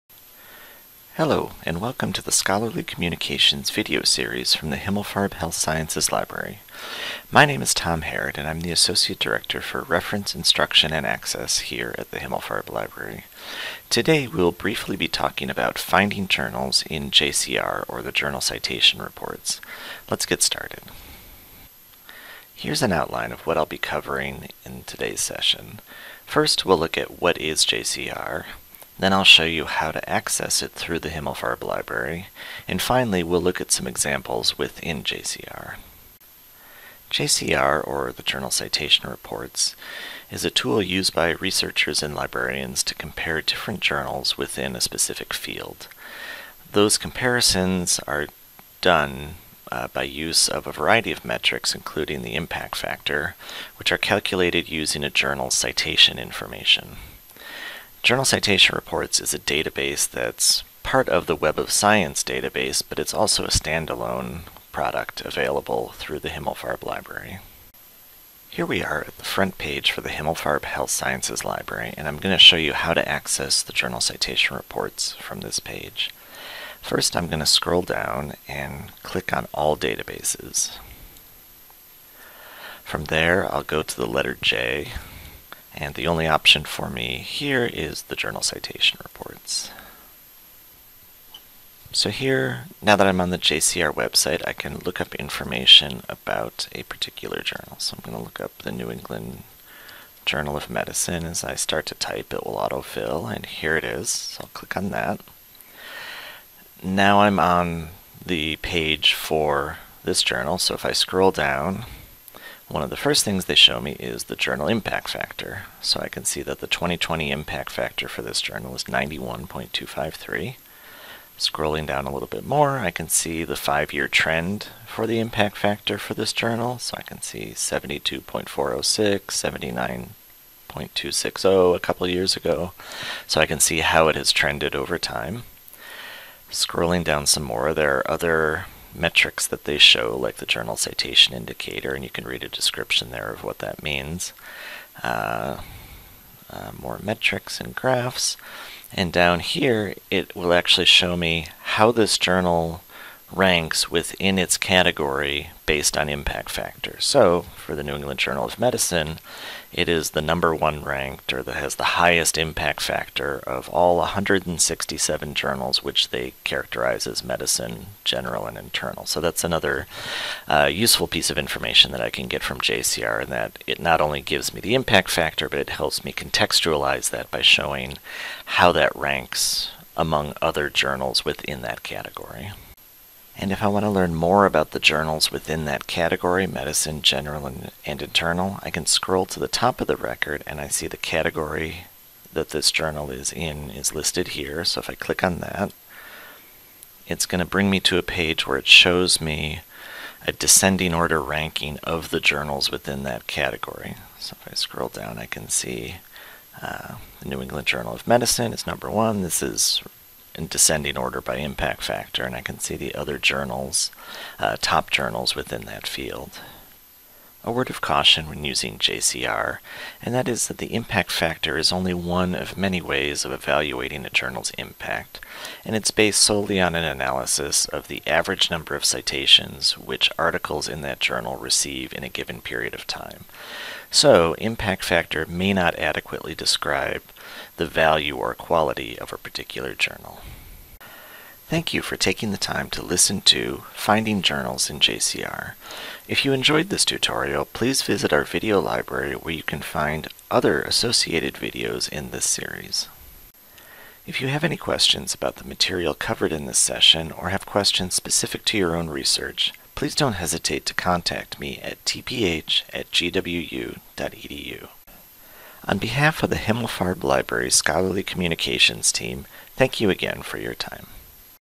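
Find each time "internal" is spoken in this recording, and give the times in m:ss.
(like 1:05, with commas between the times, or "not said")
2:48, 3:07.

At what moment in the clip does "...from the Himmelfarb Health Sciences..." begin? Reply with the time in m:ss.
0:04.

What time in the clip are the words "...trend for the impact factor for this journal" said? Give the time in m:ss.
2:04.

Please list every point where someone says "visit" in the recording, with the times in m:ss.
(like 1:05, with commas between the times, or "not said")
4:07.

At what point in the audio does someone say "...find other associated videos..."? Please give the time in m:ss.
4:09.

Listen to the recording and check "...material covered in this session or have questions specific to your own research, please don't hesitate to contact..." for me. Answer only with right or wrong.
right.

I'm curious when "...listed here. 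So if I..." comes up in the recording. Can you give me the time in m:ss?
3:13.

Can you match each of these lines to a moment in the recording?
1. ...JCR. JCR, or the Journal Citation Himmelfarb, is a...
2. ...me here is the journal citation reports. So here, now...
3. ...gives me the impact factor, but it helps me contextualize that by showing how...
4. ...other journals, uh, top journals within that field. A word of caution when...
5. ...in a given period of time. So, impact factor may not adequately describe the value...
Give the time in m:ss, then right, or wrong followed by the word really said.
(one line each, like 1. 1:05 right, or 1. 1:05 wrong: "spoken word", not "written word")
1. 0:35 wrong: "Reports", not "Himmelfarb"
2. 1:26 right
3. 2:54 right
4. 3:32 right
5. 3:51 right.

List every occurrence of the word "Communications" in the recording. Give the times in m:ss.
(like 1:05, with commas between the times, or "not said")
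0:02, 4:28.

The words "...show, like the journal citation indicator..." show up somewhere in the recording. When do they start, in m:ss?
2:19.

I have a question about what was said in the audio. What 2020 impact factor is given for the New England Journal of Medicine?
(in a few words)
91.253.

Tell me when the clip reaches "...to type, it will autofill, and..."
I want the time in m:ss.
1:41.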